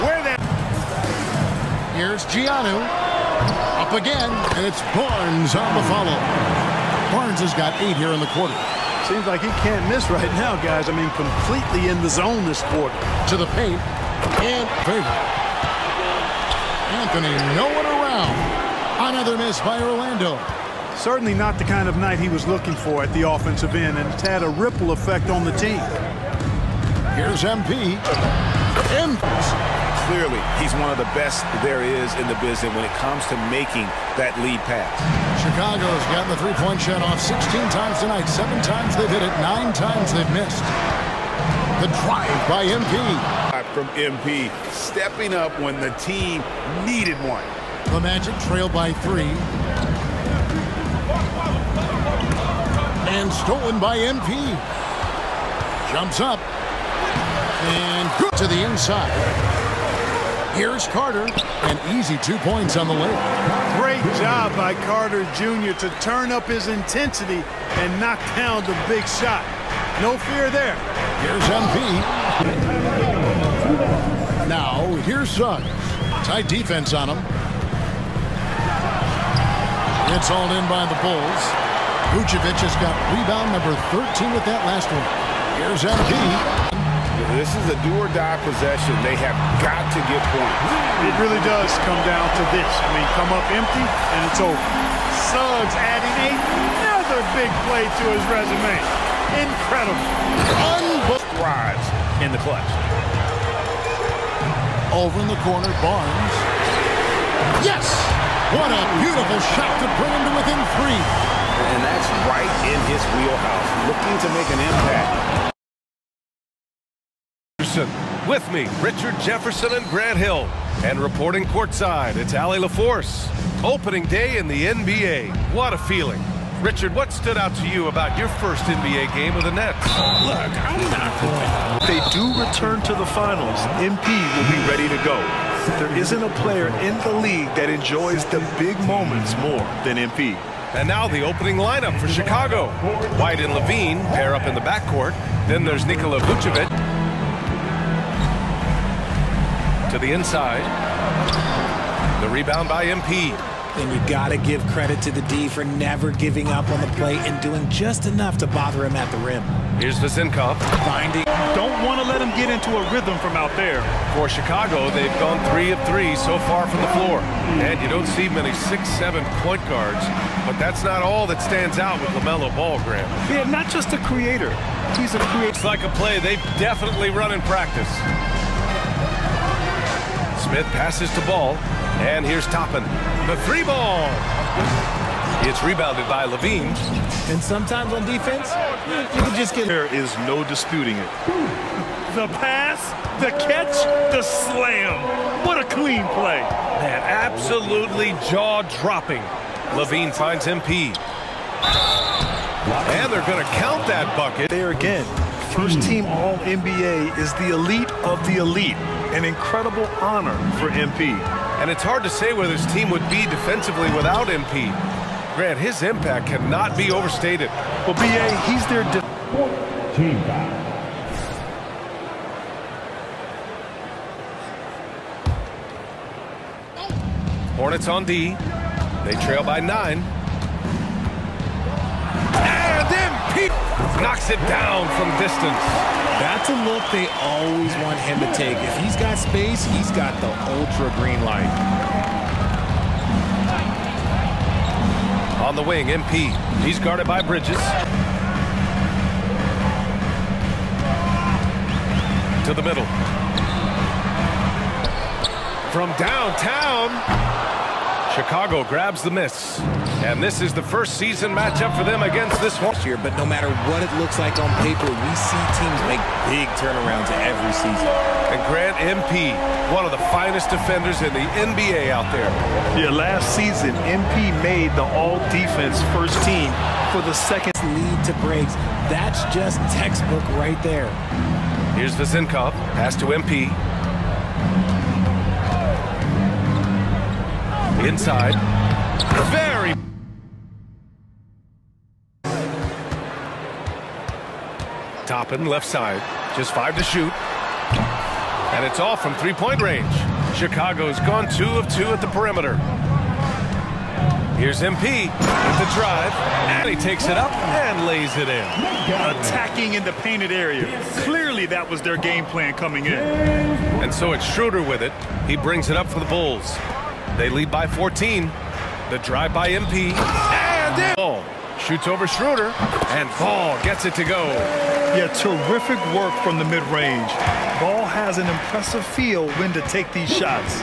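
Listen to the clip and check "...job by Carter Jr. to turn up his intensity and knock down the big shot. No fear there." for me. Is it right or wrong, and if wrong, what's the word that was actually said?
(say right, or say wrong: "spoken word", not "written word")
right.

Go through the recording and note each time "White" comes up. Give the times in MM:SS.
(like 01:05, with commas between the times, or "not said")
02:23.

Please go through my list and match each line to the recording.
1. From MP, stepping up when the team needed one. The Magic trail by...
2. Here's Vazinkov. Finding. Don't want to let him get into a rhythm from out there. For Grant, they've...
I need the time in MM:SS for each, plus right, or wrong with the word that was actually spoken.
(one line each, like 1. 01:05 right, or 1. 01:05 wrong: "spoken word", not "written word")
1. 00:43 right
2. 02:39 wrong: "Chicago", not "Grant".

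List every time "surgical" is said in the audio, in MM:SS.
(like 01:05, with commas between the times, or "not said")
not said.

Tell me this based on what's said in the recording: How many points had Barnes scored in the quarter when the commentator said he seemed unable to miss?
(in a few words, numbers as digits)
8.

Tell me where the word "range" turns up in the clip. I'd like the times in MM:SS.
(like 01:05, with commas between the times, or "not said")
04:59, 05:26.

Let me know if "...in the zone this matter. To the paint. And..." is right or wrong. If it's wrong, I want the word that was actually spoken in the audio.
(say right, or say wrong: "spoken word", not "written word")
wrong: "quarter", not "matter".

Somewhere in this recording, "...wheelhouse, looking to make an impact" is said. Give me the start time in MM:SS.
01:53.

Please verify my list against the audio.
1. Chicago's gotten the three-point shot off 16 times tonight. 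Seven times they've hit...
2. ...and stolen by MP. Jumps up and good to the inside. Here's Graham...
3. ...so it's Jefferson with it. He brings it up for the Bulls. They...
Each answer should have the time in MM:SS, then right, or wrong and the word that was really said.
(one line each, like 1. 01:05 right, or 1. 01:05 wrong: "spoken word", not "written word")
1. 00:35 right
2. 00:53 wrong: "Carter", not "Graham"
3. 05:13 wrong: "Schroeder", not "Jefferson".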